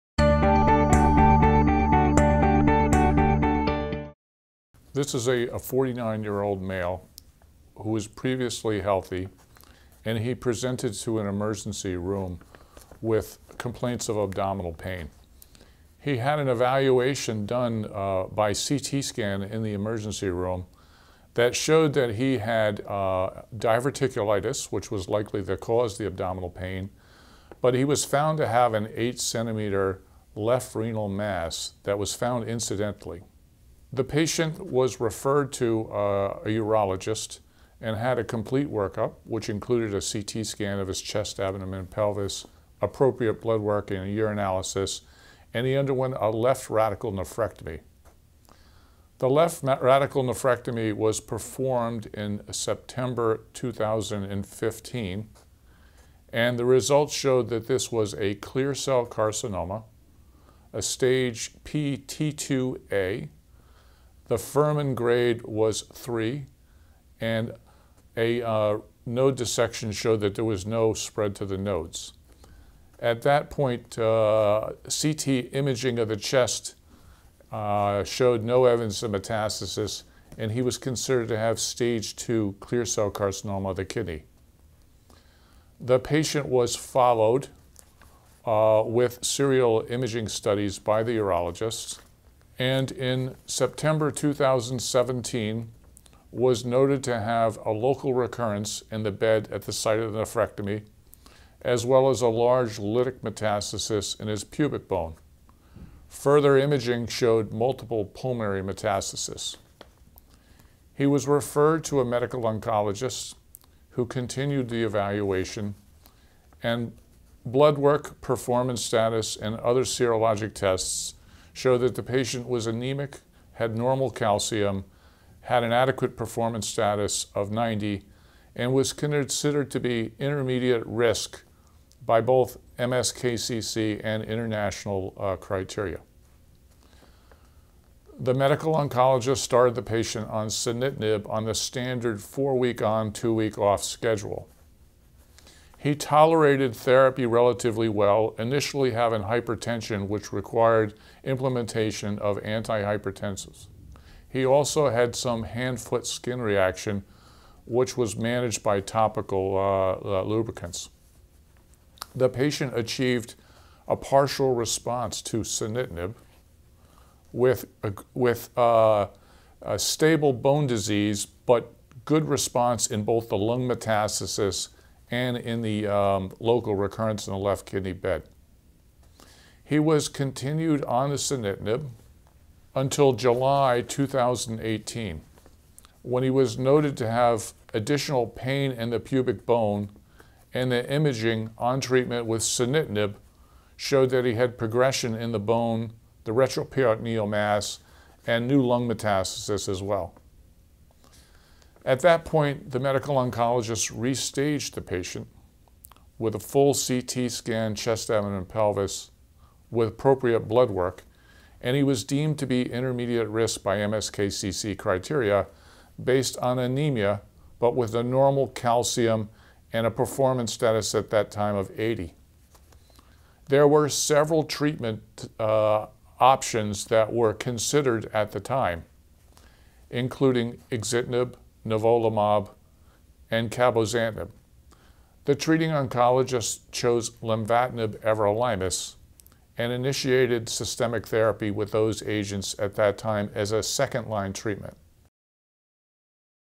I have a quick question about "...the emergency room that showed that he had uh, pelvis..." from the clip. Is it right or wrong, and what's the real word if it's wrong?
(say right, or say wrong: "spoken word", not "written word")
wrong: "diverticulitis", not "pelvis".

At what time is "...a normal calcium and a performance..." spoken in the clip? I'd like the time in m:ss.
3:37.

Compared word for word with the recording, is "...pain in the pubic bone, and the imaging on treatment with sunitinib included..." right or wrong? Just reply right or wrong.
wrong.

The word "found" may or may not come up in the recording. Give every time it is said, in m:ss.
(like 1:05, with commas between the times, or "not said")
0:28, 0:32.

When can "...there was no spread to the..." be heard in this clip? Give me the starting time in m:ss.
1:10.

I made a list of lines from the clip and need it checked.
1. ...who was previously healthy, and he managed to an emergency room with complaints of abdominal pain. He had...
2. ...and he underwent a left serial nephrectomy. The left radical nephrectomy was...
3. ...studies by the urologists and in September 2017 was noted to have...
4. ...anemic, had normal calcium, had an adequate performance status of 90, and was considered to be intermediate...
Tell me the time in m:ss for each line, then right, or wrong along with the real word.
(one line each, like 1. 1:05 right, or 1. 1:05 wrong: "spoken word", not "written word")
1. 0:07 wrong: "presented", not "managed"
2. 0:45 wrong: "radical", not "serial"
3. 1:30 right
4. 2:02 right.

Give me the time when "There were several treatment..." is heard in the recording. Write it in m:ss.
3:43.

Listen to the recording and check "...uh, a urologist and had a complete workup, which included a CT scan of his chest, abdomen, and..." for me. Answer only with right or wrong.
right.